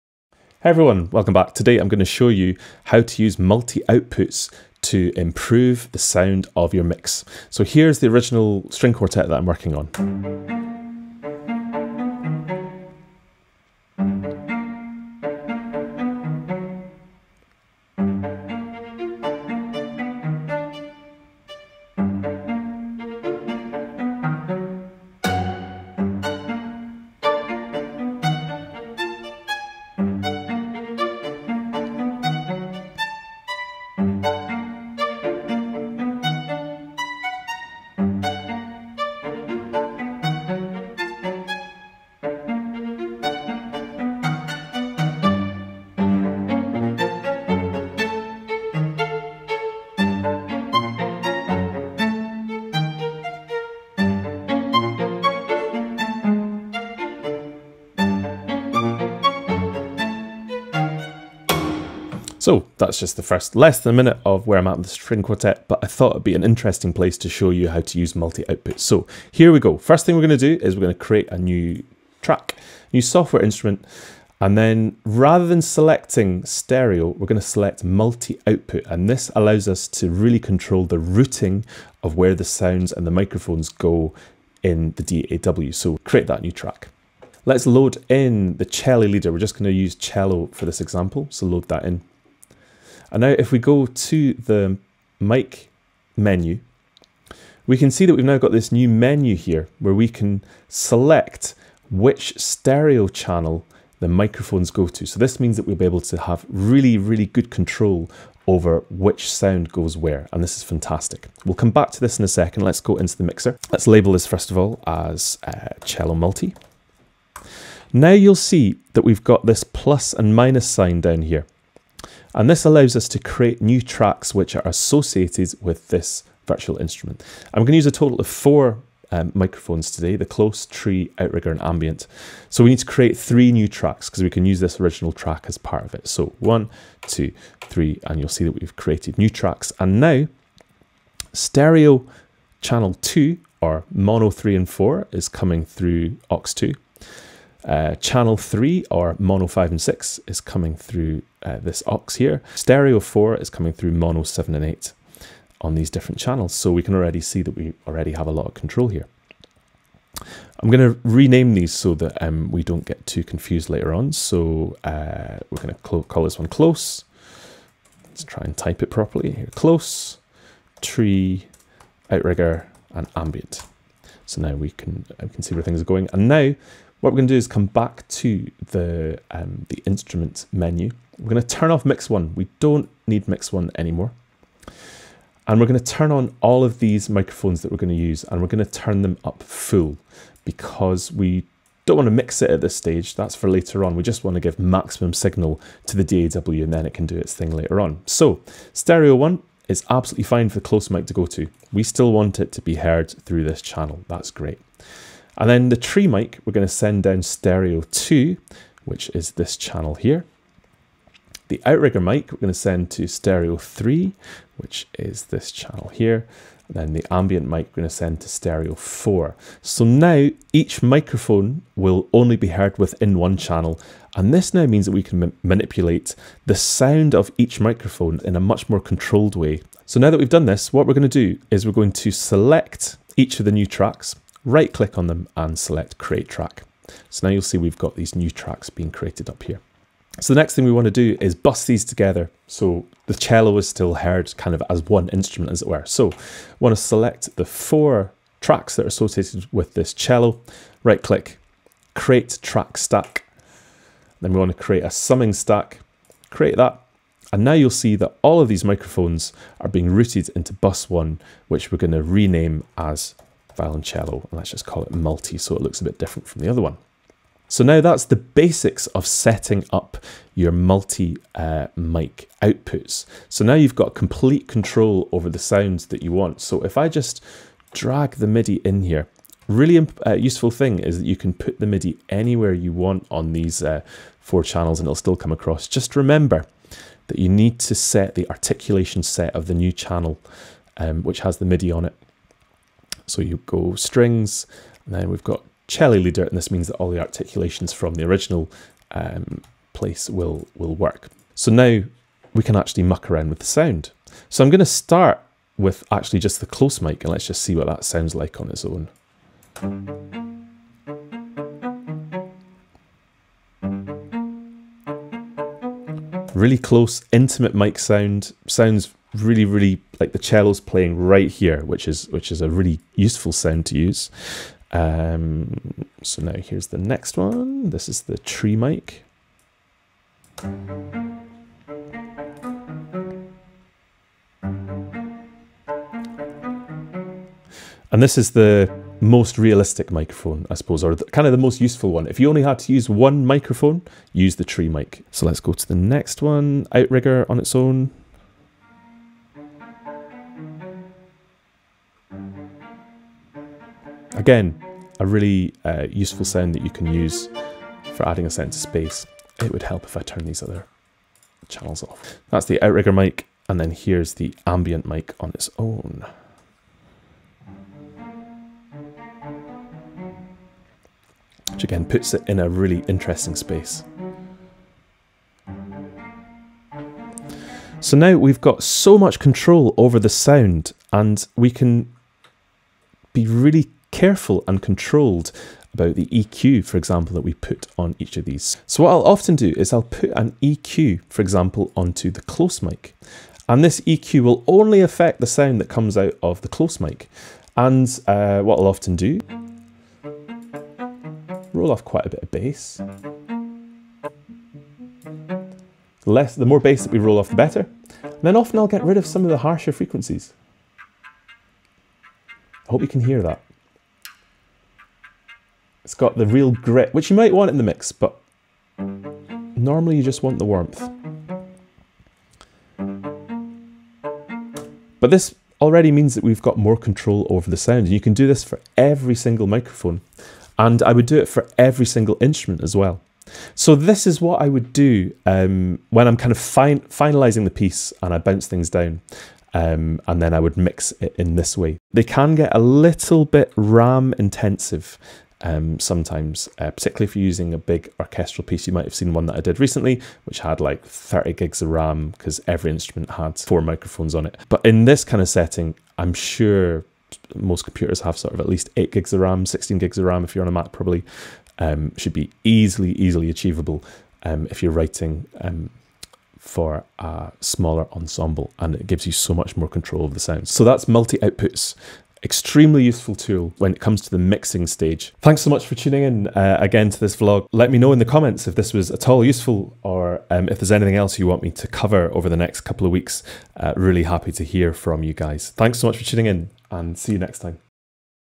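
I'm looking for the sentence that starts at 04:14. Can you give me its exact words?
Then we want to create a summing stack, create that.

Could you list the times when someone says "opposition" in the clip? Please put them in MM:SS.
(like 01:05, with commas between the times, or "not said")
not said.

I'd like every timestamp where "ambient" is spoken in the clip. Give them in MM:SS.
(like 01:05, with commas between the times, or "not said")
02:11, 02:53, 03:37, 06:04.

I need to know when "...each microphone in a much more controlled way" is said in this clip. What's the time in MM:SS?
03:47.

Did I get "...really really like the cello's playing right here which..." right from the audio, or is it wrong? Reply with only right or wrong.
right.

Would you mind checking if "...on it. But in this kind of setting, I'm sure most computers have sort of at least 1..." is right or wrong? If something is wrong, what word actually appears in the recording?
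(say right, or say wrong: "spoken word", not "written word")
wrong: "8", not "1".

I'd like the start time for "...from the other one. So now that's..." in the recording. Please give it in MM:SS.
04:26.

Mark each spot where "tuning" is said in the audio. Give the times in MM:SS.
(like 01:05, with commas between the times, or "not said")
07:55, 08:06.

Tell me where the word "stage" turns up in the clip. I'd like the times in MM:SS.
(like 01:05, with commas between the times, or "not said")
03:12, 07:54.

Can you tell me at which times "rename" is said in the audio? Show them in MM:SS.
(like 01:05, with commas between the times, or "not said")
02:41, 04:22.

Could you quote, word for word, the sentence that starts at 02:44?
So uh, we're going to call this one close.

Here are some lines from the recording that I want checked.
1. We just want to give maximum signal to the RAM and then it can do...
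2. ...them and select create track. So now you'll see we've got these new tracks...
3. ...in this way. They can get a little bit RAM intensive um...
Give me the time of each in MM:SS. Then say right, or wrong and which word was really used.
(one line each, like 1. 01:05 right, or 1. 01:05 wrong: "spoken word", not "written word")
1. 03:13 wrong: "DAW", not "RAM"
2. 03:55 right
3. 07:21 right.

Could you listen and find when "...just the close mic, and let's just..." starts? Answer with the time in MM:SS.
05:06.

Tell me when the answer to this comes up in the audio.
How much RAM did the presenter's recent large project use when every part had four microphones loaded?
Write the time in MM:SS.
07:30.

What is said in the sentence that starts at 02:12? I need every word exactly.
So we need to create three new tracks because we can use this original track as part of it.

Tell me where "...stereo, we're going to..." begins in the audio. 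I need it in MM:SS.
01:16.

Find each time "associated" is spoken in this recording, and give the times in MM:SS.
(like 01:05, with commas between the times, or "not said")
02:04, 04:08.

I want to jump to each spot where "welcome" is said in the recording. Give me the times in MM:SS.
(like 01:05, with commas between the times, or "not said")
00:01.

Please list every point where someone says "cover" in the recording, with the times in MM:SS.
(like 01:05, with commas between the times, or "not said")
08:01.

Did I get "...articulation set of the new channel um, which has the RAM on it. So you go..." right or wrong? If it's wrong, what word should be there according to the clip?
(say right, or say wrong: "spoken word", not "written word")
wrong: "MIDI", not "RAM".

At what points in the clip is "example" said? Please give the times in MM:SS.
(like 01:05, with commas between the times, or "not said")
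01:30, 06:26, 06:31.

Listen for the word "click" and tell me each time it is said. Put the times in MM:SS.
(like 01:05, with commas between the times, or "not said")
03:54, 04:11.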